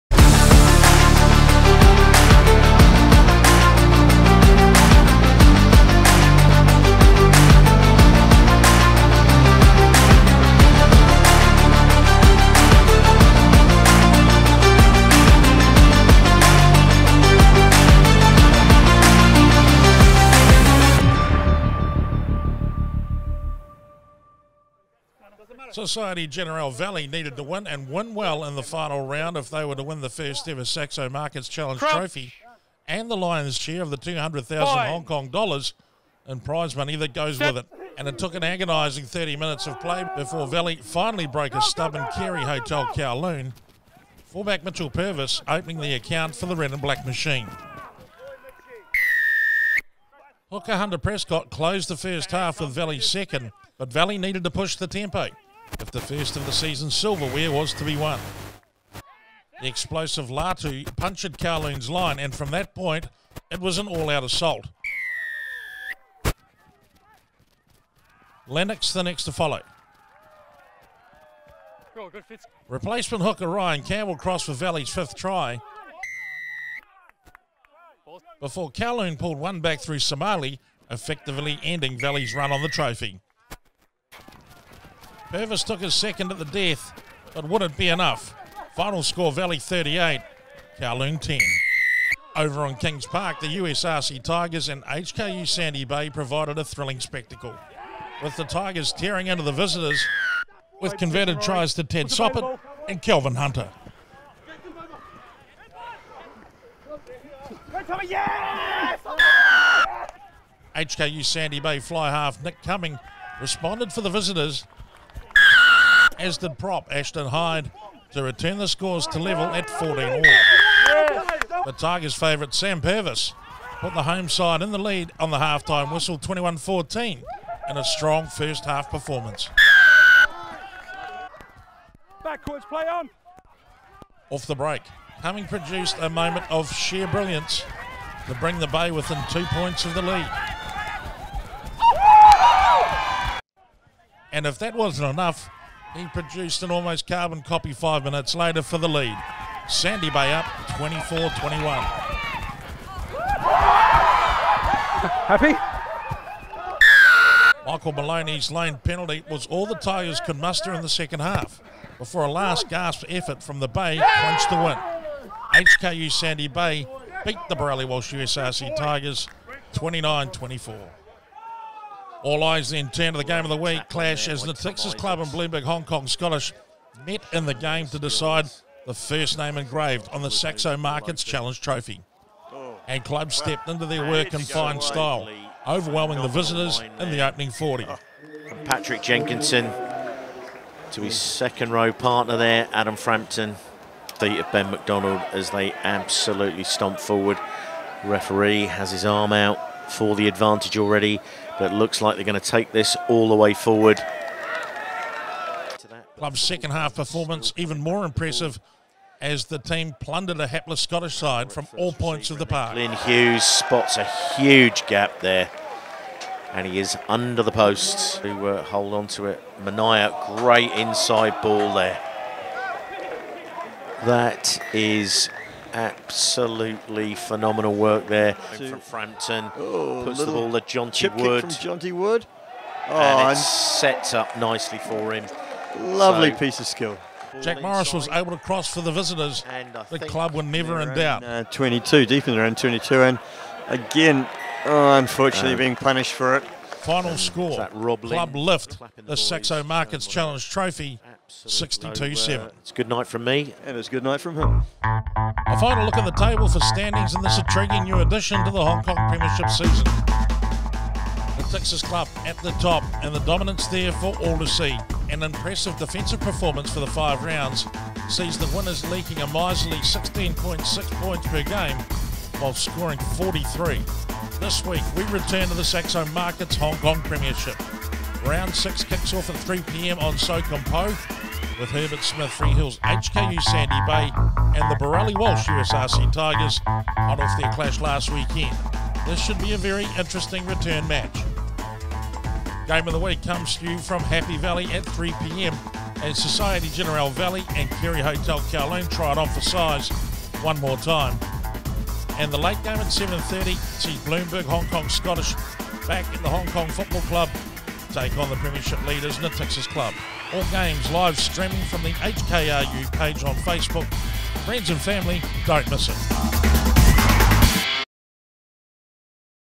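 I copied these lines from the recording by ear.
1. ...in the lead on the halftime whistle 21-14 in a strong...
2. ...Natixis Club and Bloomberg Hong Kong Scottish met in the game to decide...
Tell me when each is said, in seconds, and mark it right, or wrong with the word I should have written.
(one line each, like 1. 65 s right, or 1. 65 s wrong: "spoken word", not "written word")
1. 124 s right
2. 174 s right.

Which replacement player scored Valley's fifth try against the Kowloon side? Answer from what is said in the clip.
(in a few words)
Ryan Campbell.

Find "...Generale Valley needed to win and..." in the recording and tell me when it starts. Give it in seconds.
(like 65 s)
26 s.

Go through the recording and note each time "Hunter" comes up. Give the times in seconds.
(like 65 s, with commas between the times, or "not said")
50 s, 103 s.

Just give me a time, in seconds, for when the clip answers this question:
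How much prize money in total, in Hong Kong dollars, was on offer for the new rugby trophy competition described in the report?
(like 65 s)
33 s.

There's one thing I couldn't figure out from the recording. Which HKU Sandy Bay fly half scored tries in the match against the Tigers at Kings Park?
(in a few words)
Nick Cumming.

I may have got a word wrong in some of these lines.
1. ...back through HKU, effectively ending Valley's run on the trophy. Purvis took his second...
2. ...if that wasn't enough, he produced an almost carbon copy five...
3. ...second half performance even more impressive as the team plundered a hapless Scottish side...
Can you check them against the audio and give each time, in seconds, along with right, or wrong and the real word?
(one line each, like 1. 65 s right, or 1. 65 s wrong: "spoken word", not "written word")
1. 79 s wrong: "Somali", not "HKU"
2. 144 s right
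3. 206 s right.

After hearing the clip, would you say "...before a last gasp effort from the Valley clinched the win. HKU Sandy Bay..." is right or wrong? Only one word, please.
wrong.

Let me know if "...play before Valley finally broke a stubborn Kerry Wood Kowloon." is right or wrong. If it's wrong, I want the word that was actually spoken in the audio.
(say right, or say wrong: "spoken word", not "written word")
wrong: "Hotel", not "Wood".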